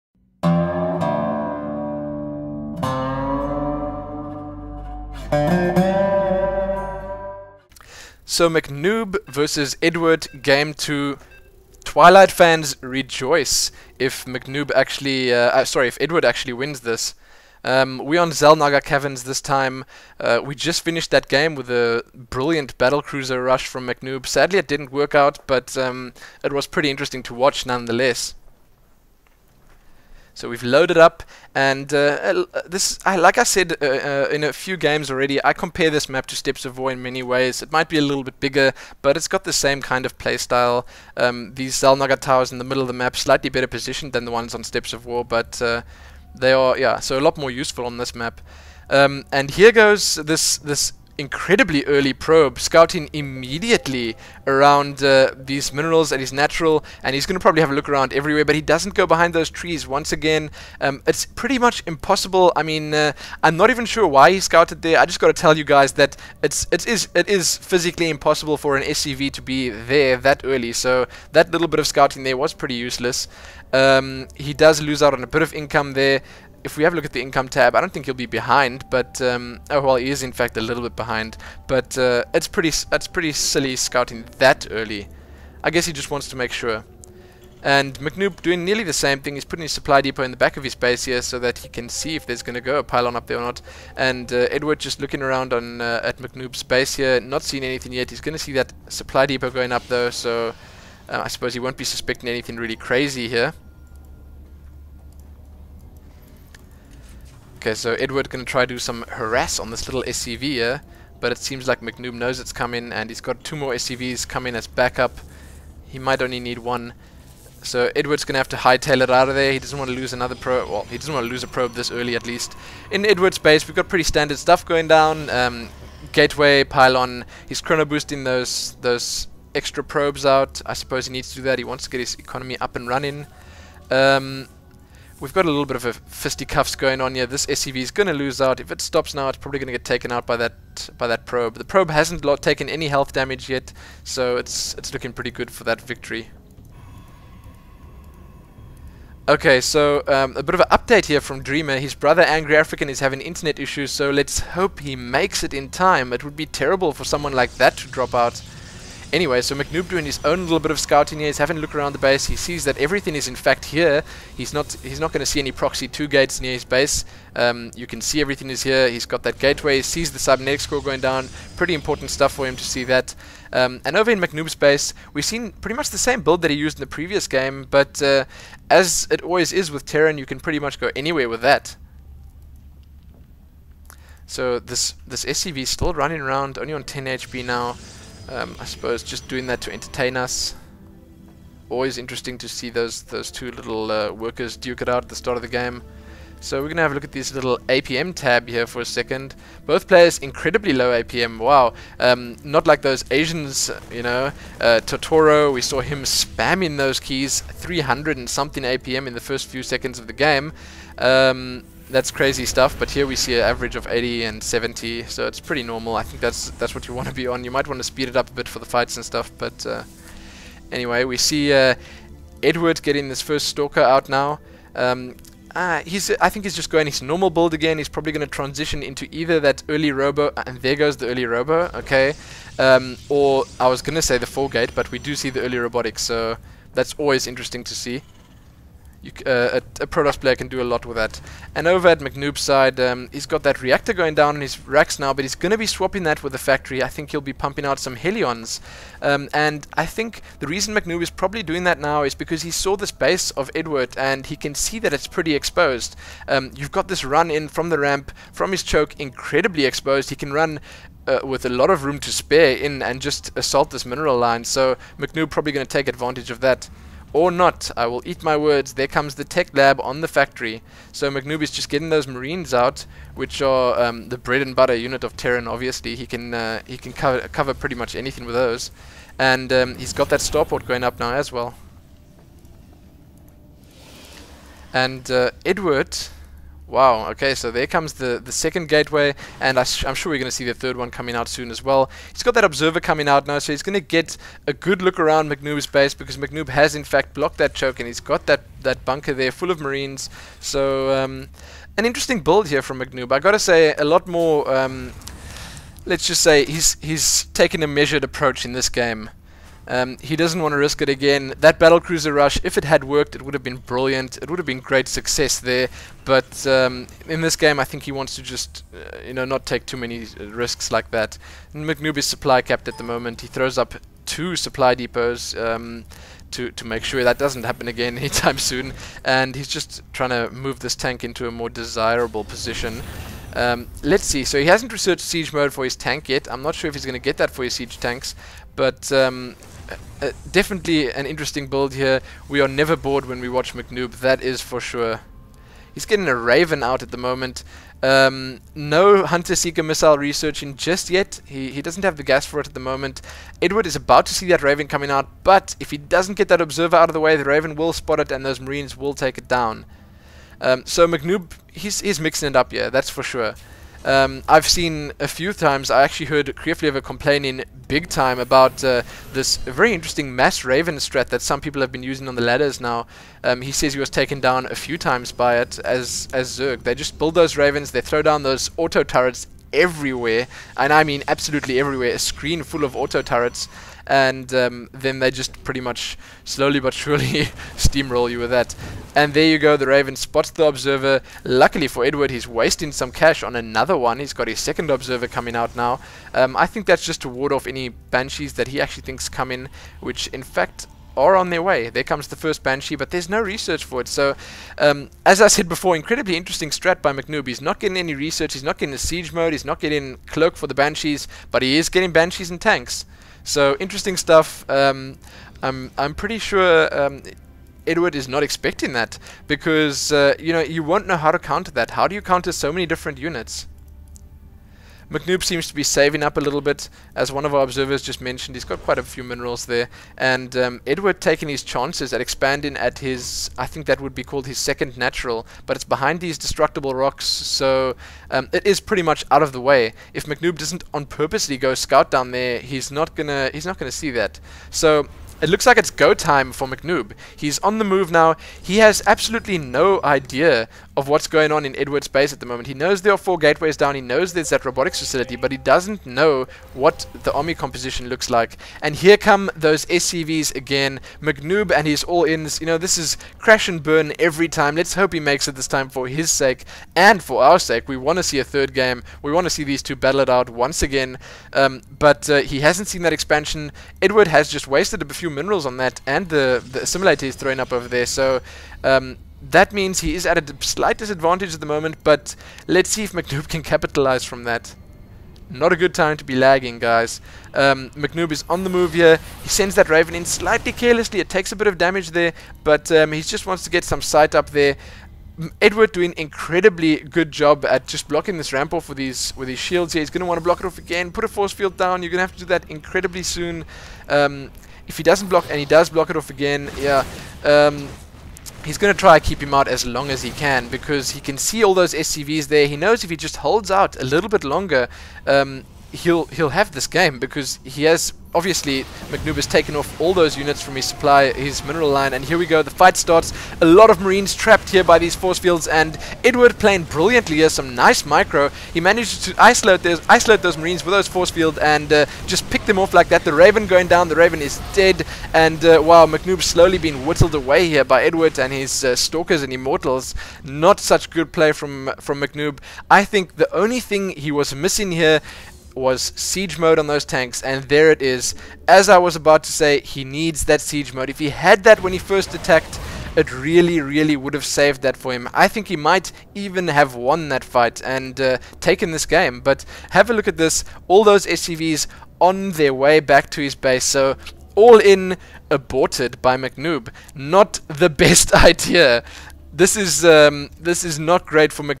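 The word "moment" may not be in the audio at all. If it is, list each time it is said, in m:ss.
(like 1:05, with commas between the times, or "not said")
5:22, 5:46, 5:52, 7:32, 8:01.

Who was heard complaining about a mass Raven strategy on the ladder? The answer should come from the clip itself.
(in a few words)
Kreeflever.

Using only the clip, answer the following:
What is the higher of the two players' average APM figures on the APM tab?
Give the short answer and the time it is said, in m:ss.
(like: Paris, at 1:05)
80, at 3:33.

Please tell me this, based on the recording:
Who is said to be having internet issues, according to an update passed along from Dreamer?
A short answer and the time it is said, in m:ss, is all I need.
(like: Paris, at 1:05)
Angry African, at 2:32.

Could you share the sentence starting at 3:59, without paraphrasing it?
You, uh, a, a, Protoss player can do a lot with that.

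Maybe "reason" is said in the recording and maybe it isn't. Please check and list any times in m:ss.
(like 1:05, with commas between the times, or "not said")
4:10.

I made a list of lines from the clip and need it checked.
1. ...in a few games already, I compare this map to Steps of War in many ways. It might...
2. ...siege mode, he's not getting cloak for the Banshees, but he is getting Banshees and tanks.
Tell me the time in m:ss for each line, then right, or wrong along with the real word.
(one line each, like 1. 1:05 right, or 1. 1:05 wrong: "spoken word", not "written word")
1. 0:34 right
2. 6:48 right.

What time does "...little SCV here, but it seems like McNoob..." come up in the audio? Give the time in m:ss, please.
1:49.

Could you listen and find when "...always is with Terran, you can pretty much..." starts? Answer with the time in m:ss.
2:59.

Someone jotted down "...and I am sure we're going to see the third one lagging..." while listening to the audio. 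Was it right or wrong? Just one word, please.
wrong.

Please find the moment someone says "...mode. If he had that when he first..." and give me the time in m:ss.
9:10.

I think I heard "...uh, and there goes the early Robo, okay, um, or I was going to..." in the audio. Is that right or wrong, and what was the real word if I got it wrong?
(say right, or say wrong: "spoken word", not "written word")
right.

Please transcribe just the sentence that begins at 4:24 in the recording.
So McNoob probably going to take advantage of that or not, I will eat my words.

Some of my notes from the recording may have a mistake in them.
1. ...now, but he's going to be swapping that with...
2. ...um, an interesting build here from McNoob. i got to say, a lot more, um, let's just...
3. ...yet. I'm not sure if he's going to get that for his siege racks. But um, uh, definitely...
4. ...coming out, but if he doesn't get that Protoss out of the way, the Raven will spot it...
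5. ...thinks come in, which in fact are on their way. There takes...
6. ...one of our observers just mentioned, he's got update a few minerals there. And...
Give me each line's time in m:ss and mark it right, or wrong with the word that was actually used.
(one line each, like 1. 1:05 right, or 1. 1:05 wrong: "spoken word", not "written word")
1. 4:04 right
2. 5:00 right
3. 5:36 wrong: "tanks", not "racks"
4. 5:54 wrong: "Observer", not "Protoss"
5. 6:38 wrong: "comes", not "takes"
6. 7:07 wrong: "quite", not "update".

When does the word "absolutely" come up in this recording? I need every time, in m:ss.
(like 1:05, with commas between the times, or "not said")
6:21, 7:28.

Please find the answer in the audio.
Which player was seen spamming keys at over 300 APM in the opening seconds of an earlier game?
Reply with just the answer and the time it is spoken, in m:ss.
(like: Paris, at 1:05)
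Totoro, at 3:24.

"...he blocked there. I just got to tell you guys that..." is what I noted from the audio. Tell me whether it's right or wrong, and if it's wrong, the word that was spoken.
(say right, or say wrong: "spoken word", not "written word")
wrong: "scouted", not "blocked".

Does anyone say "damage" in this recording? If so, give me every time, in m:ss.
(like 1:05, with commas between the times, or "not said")
2:23, 8:11.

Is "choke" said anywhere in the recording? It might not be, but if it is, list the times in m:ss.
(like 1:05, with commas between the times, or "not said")
4:18, 4:57.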